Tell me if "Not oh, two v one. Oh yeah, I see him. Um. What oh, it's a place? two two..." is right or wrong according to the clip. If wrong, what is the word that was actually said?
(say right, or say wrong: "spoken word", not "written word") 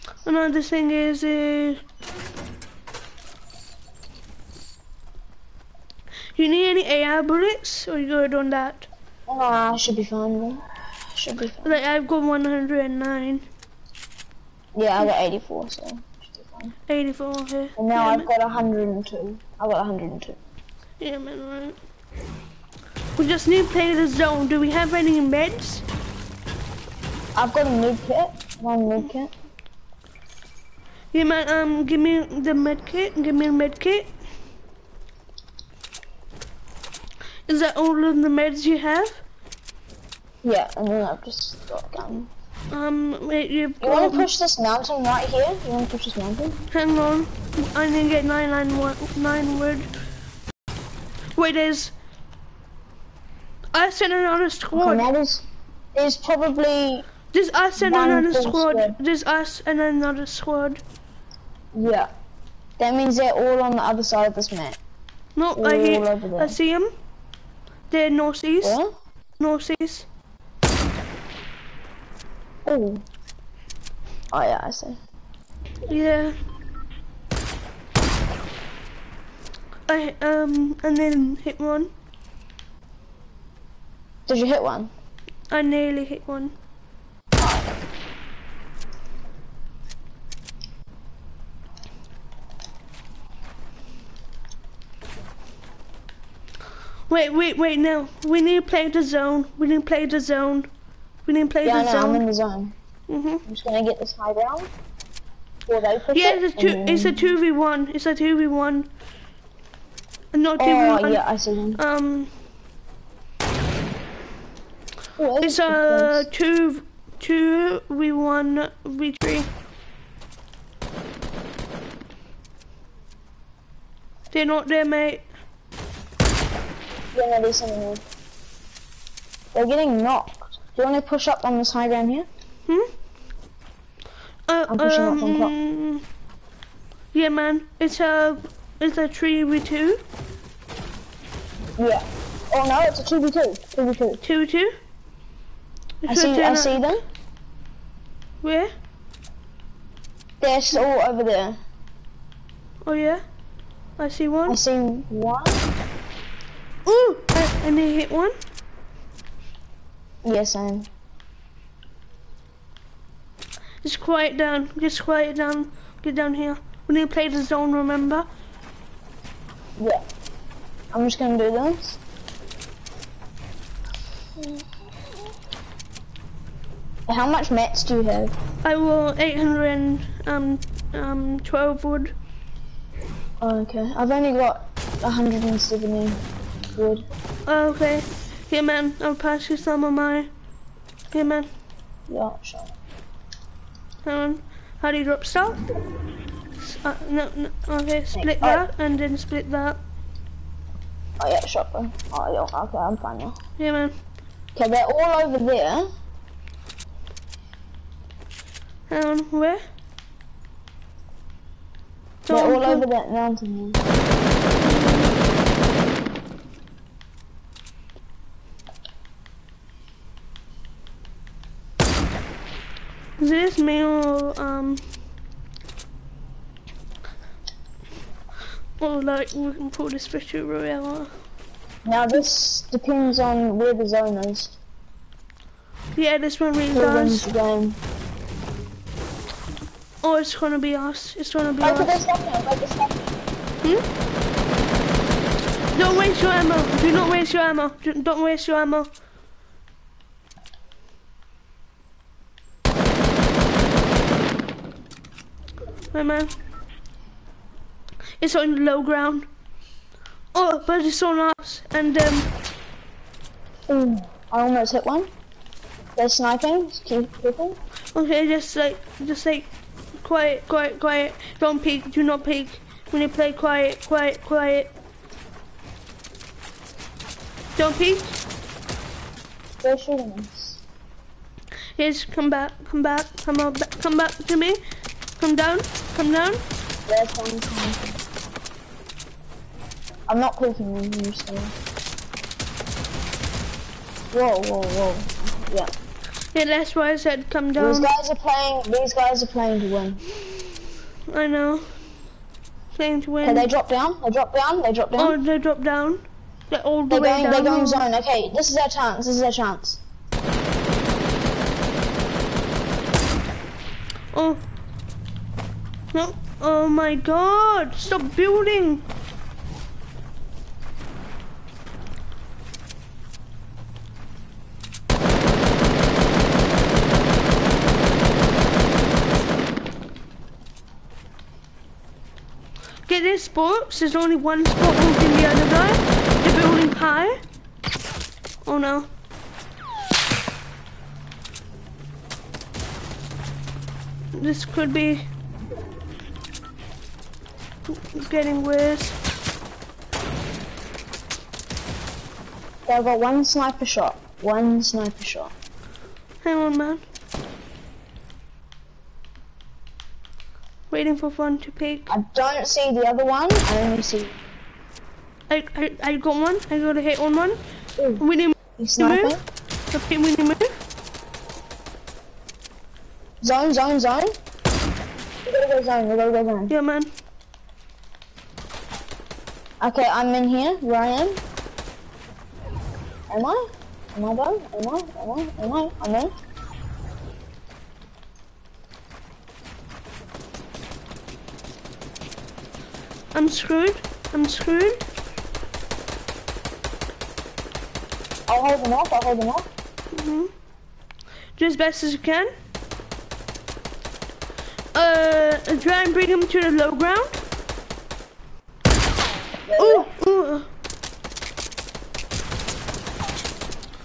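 right.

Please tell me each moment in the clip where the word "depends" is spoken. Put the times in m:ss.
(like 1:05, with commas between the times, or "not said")
3:52.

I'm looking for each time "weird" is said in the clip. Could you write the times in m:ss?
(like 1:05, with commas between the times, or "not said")
not said.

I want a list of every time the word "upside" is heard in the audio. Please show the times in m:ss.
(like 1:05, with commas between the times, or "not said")
not said.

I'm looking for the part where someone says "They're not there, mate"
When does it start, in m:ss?
2:04.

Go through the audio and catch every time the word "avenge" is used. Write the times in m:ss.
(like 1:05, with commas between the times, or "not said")
not said.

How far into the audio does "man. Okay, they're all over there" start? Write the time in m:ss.
3:23.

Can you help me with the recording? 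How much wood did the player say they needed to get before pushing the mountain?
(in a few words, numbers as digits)
919.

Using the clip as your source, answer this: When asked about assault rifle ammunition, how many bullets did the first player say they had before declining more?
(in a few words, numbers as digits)
109.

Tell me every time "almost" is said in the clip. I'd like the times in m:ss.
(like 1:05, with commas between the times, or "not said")
4:24.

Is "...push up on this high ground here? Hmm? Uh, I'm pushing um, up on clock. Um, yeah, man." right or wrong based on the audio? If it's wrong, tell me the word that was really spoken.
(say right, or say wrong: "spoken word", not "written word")
right.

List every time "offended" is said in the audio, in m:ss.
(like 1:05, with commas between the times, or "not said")
not said.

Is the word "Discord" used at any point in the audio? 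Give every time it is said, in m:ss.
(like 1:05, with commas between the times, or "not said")
not said.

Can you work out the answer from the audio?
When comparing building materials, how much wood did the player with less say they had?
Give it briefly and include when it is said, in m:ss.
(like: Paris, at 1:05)
170, at 3:05.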